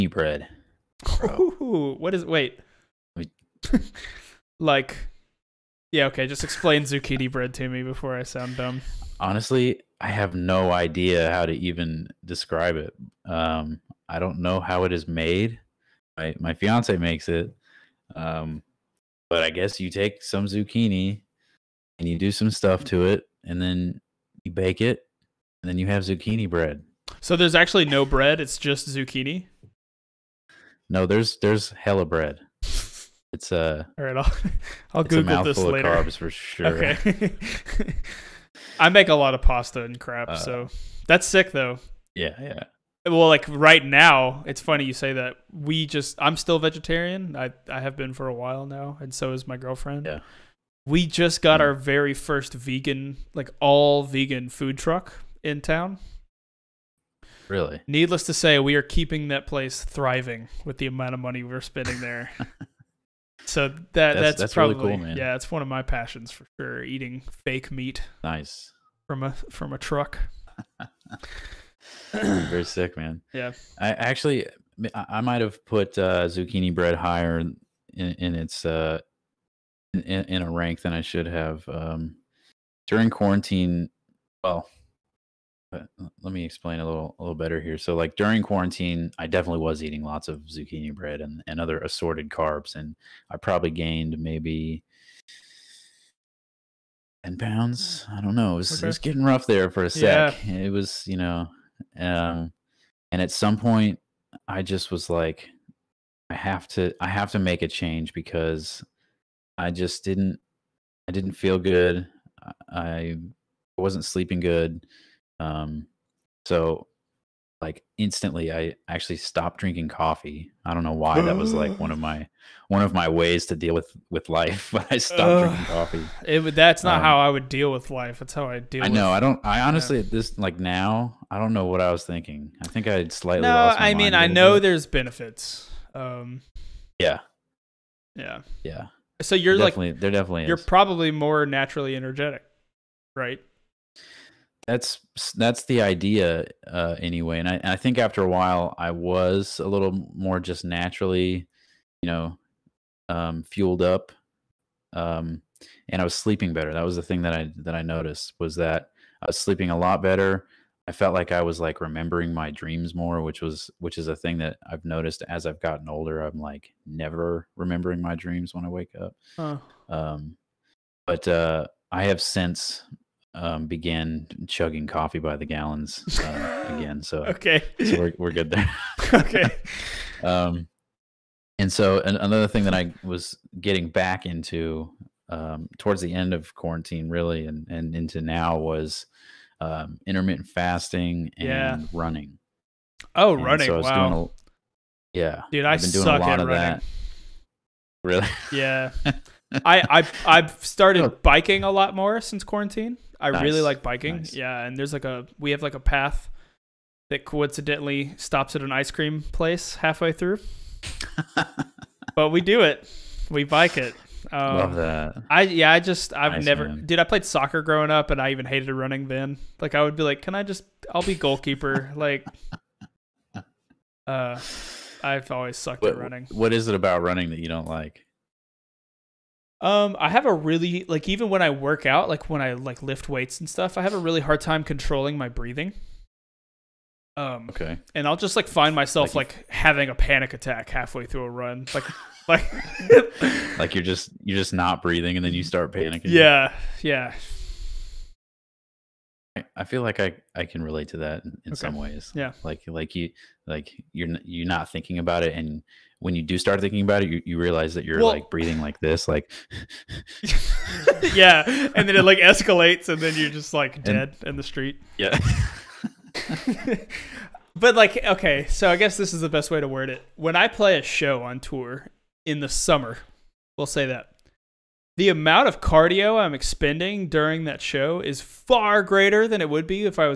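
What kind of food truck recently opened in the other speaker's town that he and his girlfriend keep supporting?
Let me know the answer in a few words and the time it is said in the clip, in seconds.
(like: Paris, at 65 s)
All vegan food truck, at 53 s.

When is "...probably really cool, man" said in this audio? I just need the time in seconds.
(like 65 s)
64 s.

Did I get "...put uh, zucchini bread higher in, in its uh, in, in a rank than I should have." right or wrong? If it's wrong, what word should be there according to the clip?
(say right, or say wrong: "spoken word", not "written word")
right.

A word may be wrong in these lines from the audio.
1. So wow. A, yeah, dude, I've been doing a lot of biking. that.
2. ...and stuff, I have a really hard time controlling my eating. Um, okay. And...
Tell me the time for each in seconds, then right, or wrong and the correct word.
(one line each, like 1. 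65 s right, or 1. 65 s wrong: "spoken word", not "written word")
1. 193 s wrong: "running", not "biking"
2. 233 s wrong: "breathing", not "eating".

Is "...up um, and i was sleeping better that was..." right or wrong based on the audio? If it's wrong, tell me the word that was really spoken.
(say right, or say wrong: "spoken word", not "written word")
right.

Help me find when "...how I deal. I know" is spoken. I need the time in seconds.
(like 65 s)
128 s.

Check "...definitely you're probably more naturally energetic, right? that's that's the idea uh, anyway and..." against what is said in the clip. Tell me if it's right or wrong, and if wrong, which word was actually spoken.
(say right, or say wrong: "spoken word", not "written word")
right.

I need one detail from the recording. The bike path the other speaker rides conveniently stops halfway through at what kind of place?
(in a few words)
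An ice cream place.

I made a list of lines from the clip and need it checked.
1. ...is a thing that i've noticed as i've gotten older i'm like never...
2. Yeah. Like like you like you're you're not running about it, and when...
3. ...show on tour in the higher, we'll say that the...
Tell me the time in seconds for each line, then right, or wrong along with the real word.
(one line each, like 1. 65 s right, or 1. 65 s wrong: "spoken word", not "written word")
1. 163 s right
2. 252 s wrong: "thinking", not "running"
3. 270 s wrong: "summer", not "higher".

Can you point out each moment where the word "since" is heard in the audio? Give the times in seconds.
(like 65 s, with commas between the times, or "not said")
172 s, 202 s.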